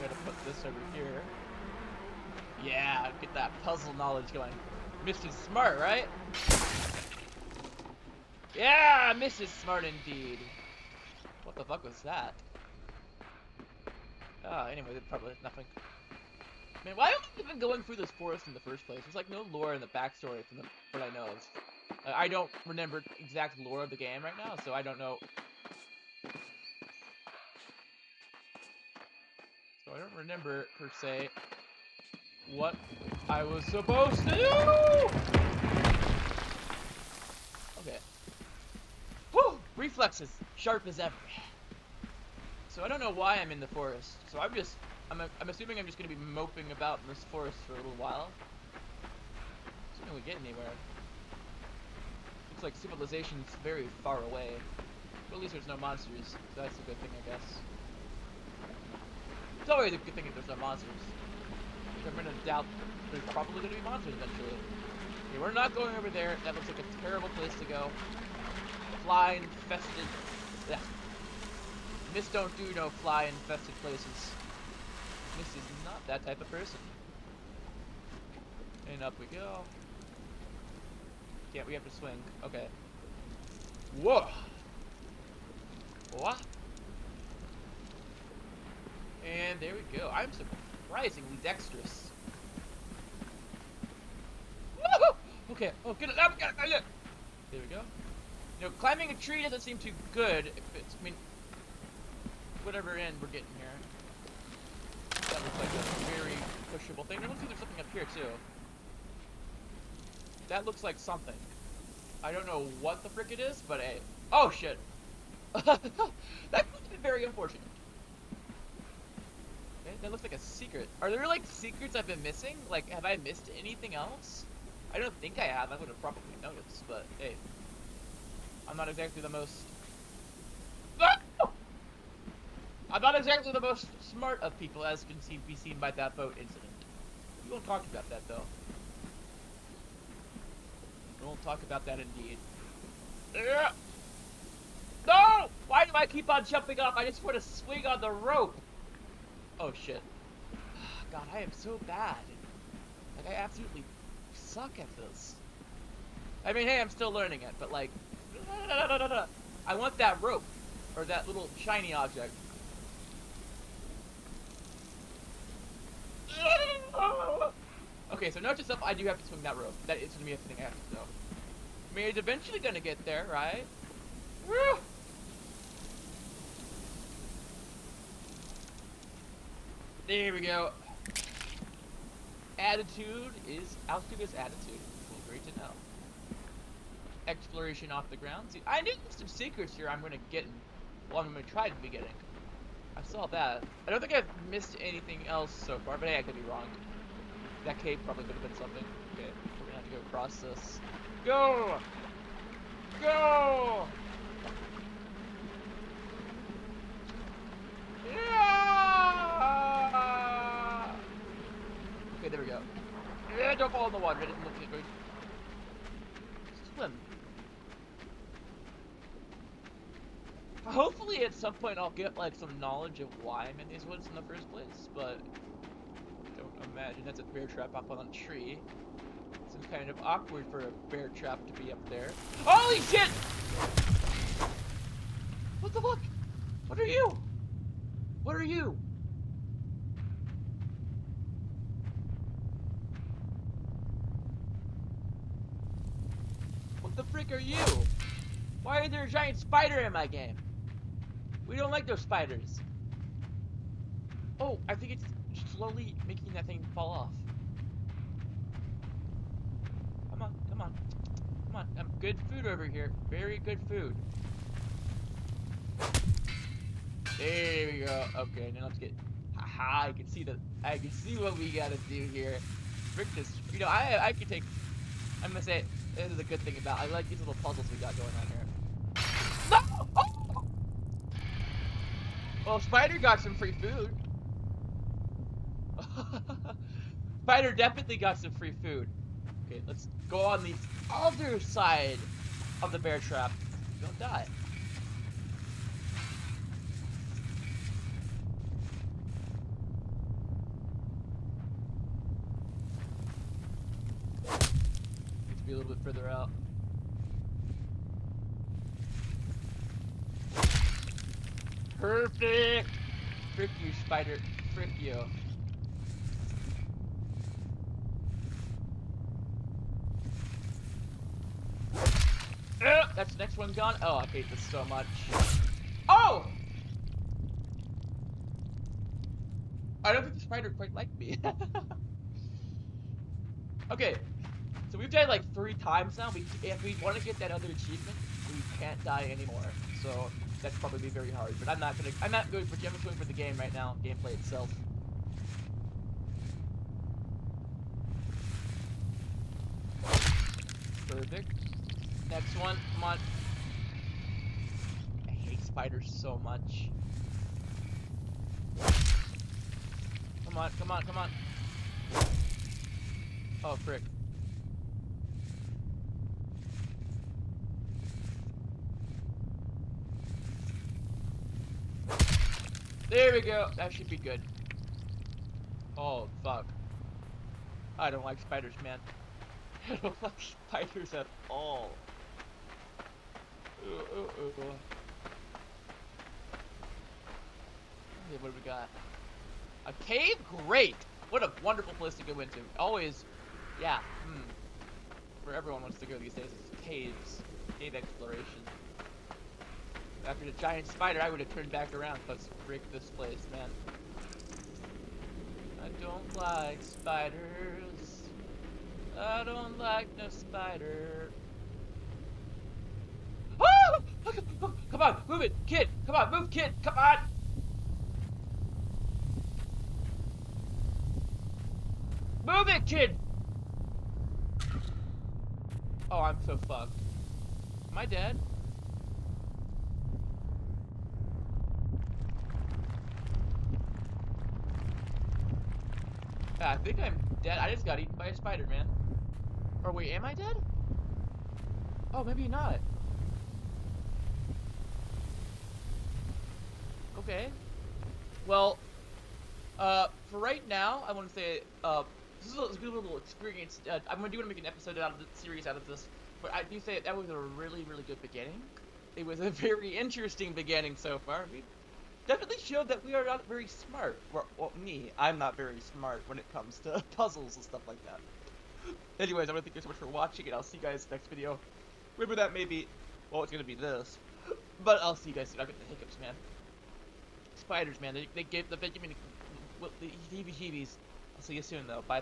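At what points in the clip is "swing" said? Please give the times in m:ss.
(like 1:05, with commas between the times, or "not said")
1:21, 2:27, 2:49.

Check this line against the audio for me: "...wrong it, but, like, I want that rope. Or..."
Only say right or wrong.
wrong.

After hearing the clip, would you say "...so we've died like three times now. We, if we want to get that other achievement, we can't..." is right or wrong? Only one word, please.
right.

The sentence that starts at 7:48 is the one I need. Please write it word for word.
Anyways, I want to thank you so much for watching, and I'll see you guys next video.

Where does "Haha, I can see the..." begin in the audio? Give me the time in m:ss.
4:29.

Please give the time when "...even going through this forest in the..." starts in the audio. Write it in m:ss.
0:17.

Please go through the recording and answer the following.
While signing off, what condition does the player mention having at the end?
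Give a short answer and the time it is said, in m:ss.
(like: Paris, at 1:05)
Hiccups, at 7:55.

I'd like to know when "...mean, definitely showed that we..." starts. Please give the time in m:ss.
7:41.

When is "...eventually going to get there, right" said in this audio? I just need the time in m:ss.
2:52.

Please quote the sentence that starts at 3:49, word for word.
It's kind of awkward for a bear trap to be up there.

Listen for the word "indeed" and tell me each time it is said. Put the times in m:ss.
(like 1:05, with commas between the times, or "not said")
0:09, 2:22.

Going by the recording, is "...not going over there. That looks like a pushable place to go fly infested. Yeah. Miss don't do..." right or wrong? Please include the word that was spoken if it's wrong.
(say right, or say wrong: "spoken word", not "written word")
wrong: "terrible", not "pushable".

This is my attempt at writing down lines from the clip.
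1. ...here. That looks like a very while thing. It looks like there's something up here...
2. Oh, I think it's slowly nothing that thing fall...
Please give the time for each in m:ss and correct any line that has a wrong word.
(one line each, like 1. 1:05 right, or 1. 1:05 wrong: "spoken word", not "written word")
1. 1:43 wrong: "pushable", not "while"
2. 4:14 wrong: "making", not "nothing".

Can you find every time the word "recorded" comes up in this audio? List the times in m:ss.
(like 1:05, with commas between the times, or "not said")
not said.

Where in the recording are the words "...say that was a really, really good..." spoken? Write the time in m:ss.
7:36.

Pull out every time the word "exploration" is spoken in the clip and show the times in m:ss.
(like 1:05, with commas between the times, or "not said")
3:07, 6:37.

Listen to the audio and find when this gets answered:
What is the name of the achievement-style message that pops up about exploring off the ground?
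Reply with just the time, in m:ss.
3:02.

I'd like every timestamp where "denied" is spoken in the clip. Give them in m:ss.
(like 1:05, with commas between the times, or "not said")
not said.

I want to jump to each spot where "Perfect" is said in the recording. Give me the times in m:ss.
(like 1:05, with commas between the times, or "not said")
5:11, 5:50.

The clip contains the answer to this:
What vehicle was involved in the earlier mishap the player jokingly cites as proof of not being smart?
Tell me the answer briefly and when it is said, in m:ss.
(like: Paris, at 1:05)
Boat, at 2:16.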